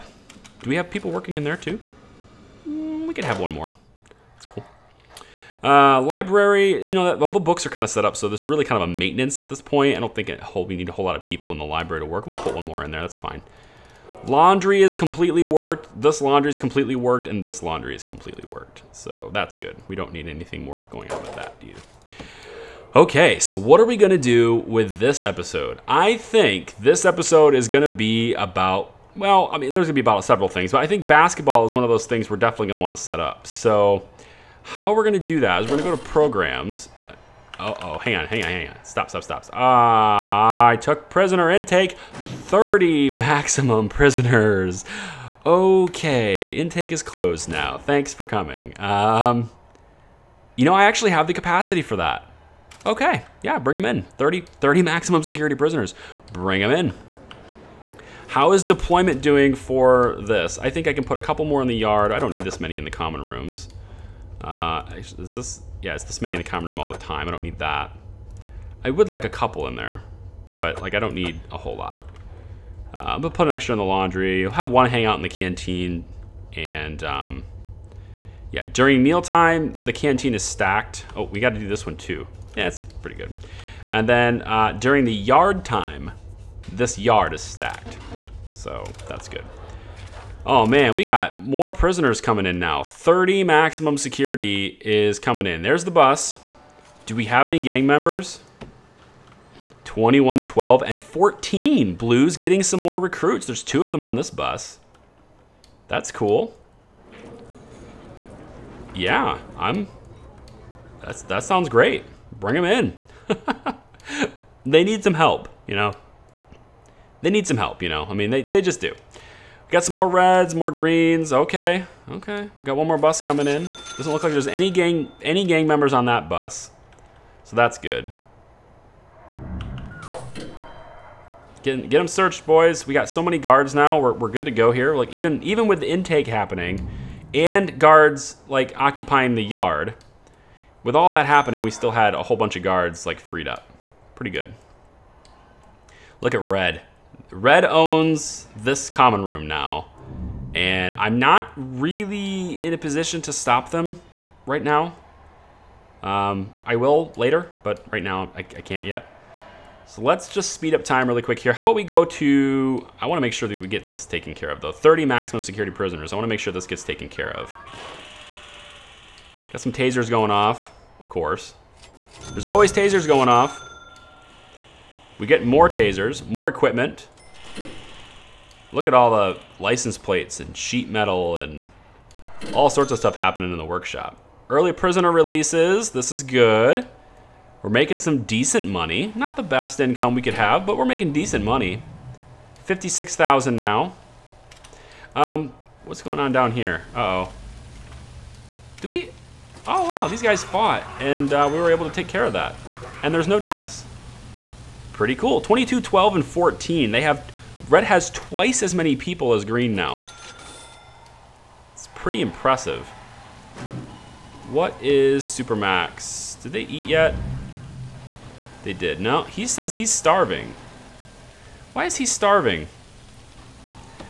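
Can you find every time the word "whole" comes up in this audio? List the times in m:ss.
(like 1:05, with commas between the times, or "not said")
0:10, 1:11, 2:22.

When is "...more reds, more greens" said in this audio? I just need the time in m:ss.
1:59.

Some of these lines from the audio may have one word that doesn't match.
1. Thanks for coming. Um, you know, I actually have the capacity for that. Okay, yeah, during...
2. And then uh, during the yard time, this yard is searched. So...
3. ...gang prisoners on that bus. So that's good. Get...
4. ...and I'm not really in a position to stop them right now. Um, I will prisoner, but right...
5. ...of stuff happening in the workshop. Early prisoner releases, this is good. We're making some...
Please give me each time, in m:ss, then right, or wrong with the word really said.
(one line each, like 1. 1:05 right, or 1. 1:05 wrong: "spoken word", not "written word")
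1. 0:47 wrong: "bring", not "during"
2. 1:23 wrong: "stacked", not "searched"
3. 2:05 wrong: "members", not "prisoners"
4. 2:30 wrong: "later", not "prisoner"
5. 3:02 right.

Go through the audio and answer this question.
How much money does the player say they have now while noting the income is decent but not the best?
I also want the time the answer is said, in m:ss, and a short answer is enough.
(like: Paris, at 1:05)
56,000, at 3:12.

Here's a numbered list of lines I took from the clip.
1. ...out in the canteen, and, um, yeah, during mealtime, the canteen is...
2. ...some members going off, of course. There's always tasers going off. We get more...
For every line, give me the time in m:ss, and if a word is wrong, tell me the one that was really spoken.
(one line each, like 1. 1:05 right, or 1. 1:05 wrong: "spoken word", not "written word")
1. 1:15 right
2. 2:49 wrong: "tasers", not "members".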